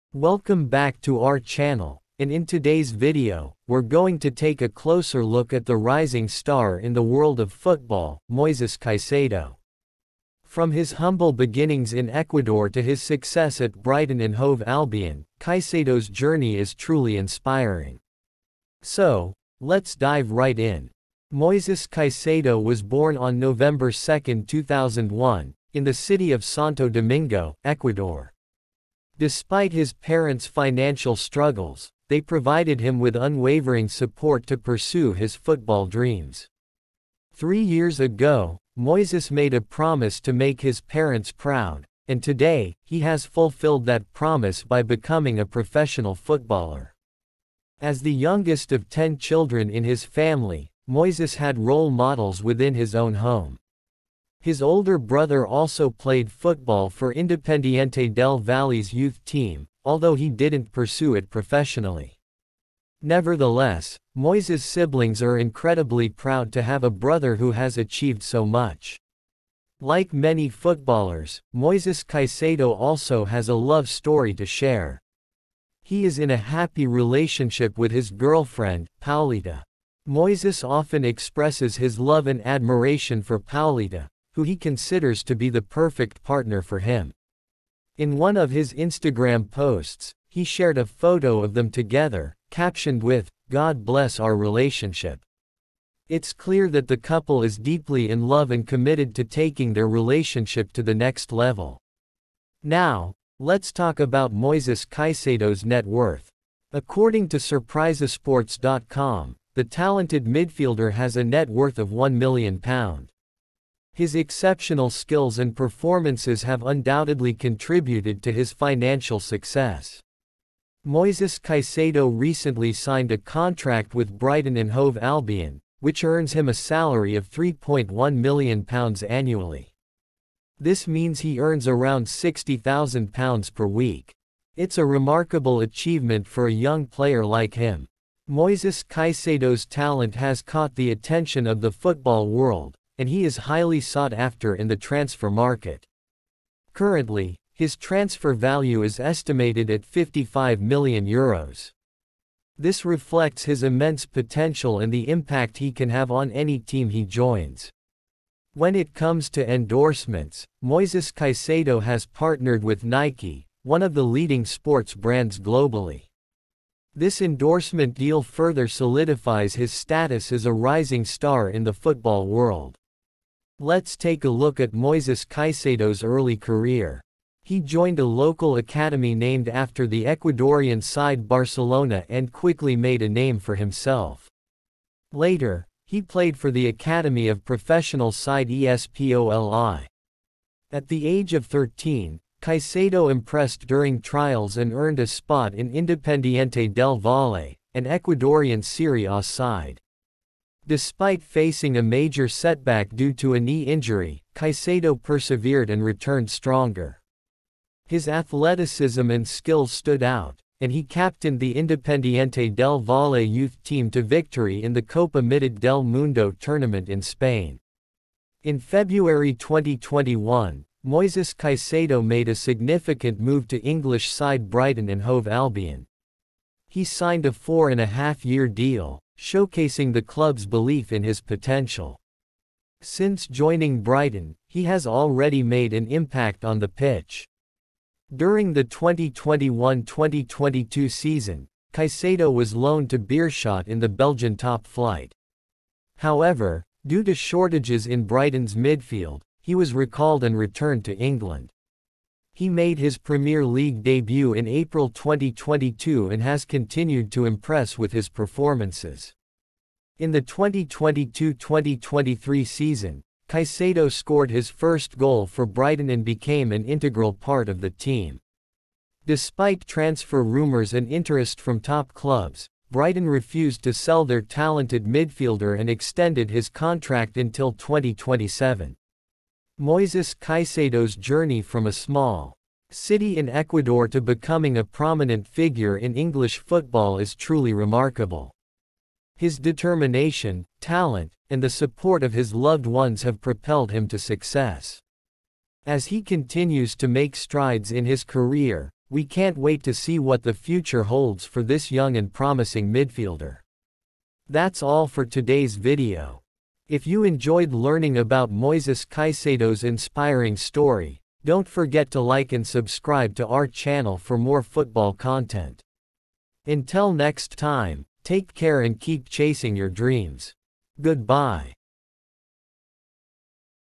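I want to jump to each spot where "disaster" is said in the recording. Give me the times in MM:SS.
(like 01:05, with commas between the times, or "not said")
not said.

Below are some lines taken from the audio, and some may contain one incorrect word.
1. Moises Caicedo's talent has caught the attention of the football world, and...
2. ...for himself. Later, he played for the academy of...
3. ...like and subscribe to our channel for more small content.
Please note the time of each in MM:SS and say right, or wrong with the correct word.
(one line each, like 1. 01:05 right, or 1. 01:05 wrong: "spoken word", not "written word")
1. 02:18 right
2. 03:03 right
3. 05:12 wrong: "football", not "small".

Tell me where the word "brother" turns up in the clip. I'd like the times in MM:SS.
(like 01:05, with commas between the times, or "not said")
00:54, 01:06.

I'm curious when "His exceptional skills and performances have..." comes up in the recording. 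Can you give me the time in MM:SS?
01:54.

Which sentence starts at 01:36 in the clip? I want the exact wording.
It's clear that the couple is deeply in love and committed to taking their relationship to the next level.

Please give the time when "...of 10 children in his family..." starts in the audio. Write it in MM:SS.
00:48.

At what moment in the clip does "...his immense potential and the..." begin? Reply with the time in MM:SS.
02:33.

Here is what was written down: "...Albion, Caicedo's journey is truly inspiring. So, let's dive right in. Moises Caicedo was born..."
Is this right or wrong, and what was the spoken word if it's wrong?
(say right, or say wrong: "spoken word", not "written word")
right.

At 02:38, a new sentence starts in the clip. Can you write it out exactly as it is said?
When it comes to endorsements, Moises Caicedo has partnered with Nike, one of the leading sports brands globally.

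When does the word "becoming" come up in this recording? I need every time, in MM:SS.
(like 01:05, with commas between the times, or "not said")
00:44, 04:44.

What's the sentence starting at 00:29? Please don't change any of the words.
Despite his parents' financial struggles, they provided him with unwavering support to pursue his football dreams.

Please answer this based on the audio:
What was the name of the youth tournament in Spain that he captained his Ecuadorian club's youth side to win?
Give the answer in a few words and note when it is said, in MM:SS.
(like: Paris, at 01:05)
Copa Mitad del Mundo, at 03:34.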